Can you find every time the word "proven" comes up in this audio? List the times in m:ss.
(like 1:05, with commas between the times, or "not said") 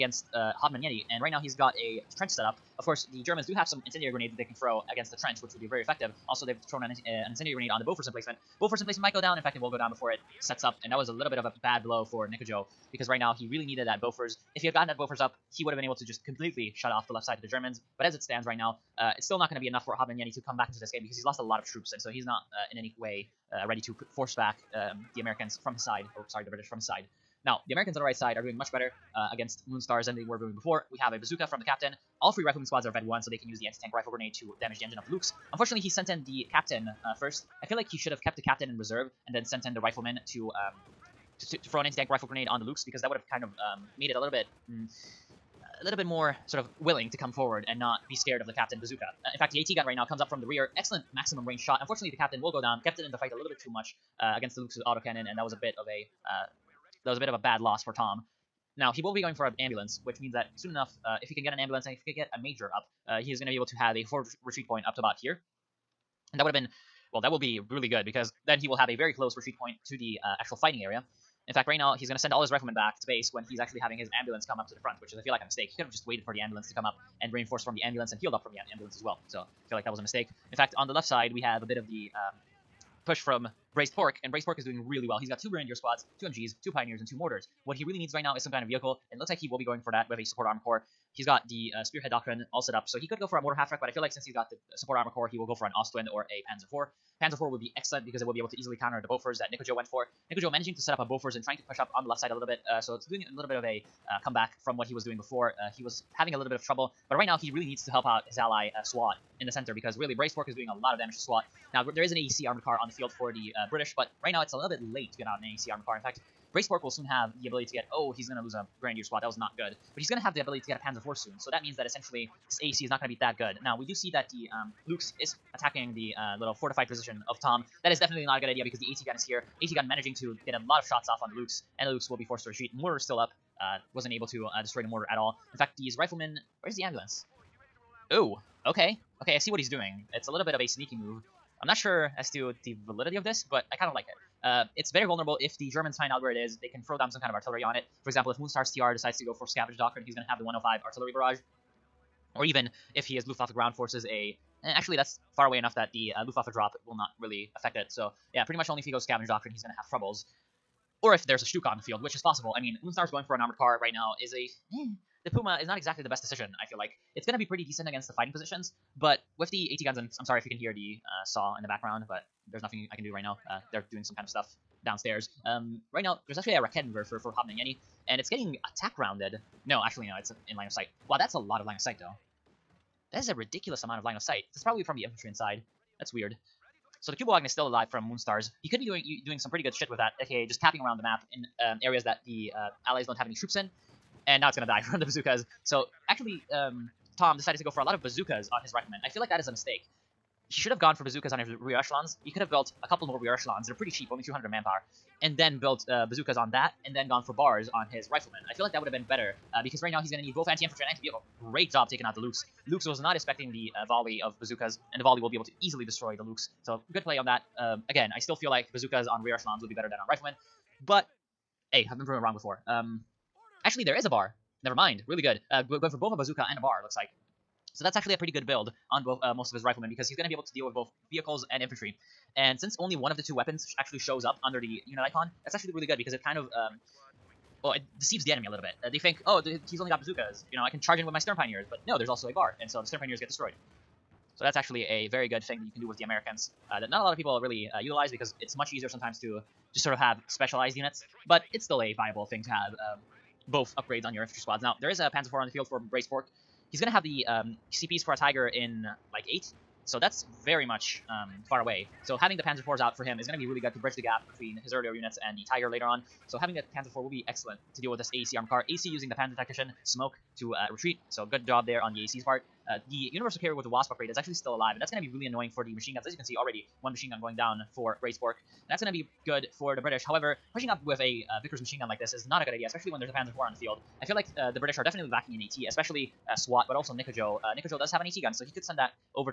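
3:42.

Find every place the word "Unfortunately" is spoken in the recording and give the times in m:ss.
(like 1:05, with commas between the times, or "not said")
0:35, 0:51.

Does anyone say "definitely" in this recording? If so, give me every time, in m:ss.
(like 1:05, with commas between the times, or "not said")
2:07, 4:44.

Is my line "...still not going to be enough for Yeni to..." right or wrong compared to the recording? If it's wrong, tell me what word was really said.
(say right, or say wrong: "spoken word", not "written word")
right.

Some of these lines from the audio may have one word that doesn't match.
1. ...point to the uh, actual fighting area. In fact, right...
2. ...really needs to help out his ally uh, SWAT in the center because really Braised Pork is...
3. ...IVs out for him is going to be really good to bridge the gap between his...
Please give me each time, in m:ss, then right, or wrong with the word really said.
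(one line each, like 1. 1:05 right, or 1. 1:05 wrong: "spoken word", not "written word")
1. 1:09 right
2. 1:47 right
3. 4:22 right.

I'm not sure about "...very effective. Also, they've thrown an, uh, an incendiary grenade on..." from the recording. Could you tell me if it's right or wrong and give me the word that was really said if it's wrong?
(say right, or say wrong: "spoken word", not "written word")
right.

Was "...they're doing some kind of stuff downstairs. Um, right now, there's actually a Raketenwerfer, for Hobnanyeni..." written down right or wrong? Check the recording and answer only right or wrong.
right.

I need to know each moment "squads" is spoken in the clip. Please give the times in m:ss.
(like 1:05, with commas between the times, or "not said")
0:32, 1:25, 1:59, 4:14.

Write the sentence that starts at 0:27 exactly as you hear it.
Now, the Americans on the right side are doing much better uh, against Moonstars than they were doing before.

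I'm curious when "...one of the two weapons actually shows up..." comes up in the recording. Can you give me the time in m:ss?
3:52.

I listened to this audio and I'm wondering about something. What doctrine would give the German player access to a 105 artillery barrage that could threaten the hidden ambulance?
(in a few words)
Scavenge Doctrine.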